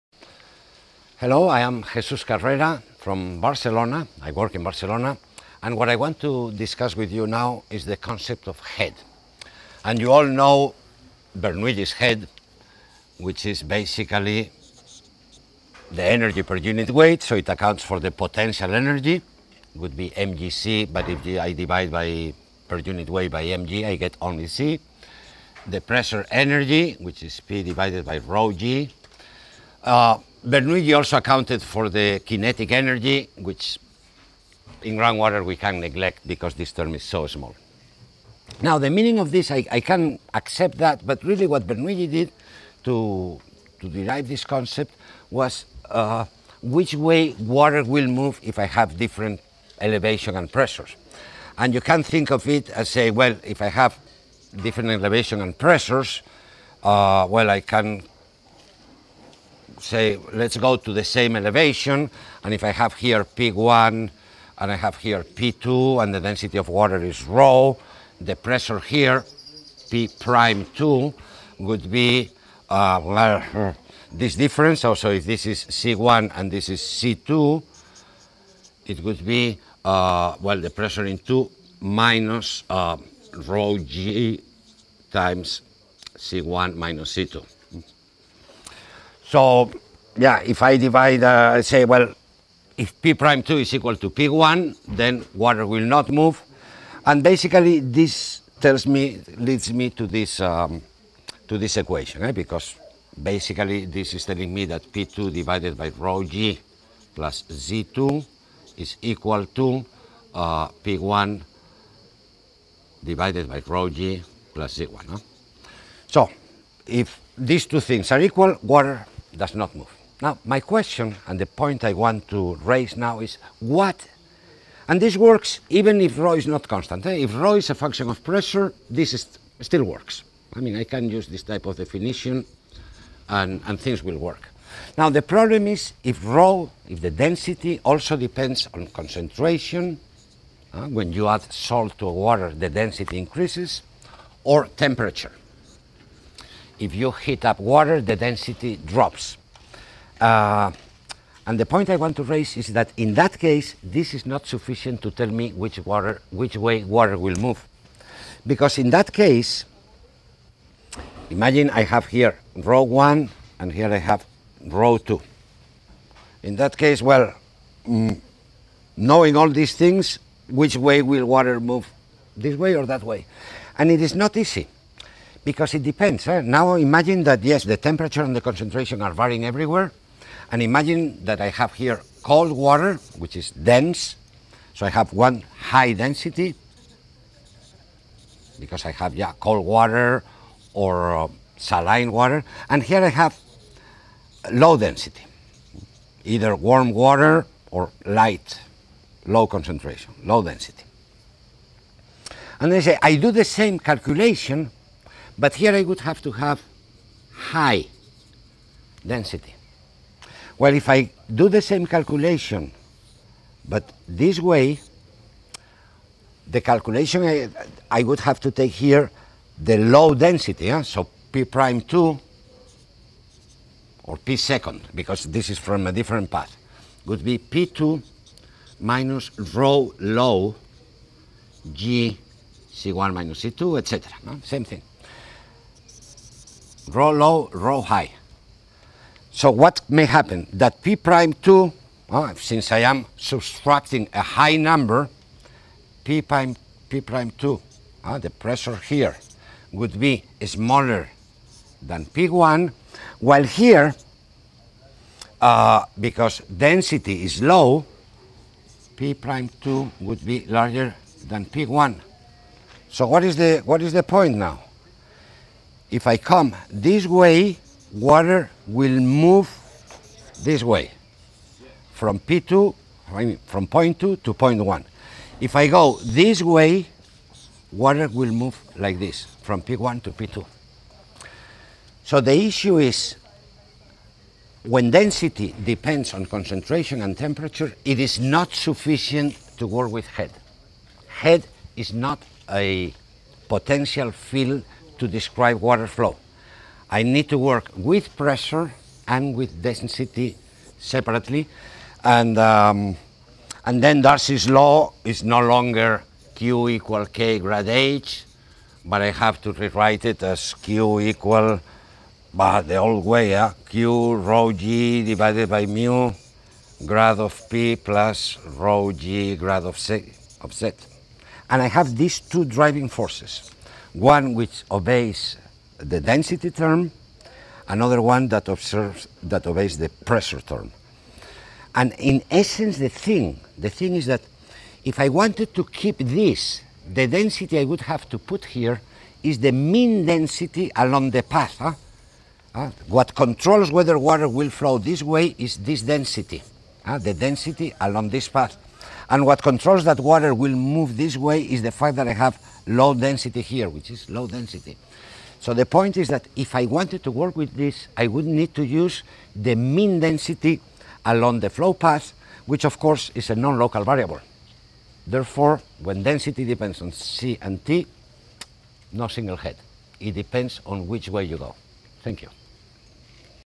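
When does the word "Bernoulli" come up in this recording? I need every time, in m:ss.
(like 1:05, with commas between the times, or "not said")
0:11, 0:30, 0:41.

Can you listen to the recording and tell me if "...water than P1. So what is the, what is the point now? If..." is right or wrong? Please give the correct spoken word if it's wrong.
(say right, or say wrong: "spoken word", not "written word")
wrong: "larger", not "water".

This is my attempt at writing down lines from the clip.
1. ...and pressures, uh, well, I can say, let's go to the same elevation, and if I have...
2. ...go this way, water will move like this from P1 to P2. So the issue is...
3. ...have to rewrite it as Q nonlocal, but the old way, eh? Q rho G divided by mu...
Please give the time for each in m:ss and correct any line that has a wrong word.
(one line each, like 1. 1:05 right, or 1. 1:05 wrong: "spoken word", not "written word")
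1. 0:55 right
2. 4:35 right
3. 5:09 wrong: "equal", not "nonlocal".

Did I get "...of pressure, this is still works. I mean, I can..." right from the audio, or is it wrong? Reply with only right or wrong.
right.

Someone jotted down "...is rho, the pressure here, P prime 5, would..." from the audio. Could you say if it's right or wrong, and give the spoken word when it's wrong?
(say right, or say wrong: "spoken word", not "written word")
wrong: "2", not "5".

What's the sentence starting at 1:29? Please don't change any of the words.
So, yeah, if I divide, uh, I say, well, if P prime 2 is equal to P1, then water will not move.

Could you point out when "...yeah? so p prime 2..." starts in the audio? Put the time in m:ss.
3:40.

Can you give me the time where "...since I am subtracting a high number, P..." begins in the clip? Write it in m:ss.
4:02.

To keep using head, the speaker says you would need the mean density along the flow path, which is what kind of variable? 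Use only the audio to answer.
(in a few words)
non-local variable.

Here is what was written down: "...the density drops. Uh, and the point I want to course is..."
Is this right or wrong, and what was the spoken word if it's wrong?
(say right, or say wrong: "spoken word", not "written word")
wrong: "raise", not "course".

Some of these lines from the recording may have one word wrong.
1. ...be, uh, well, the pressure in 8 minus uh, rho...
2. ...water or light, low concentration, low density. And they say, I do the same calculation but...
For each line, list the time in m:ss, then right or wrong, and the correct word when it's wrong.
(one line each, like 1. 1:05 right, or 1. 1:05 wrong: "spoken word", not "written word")
1. 1:19 wrong: "2", not "8"
2. 3:16 right.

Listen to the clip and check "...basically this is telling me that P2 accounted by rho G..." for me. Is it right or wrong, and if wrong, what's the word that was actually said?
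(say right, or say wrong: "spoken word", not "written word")
wrong: "divided", not "accounted".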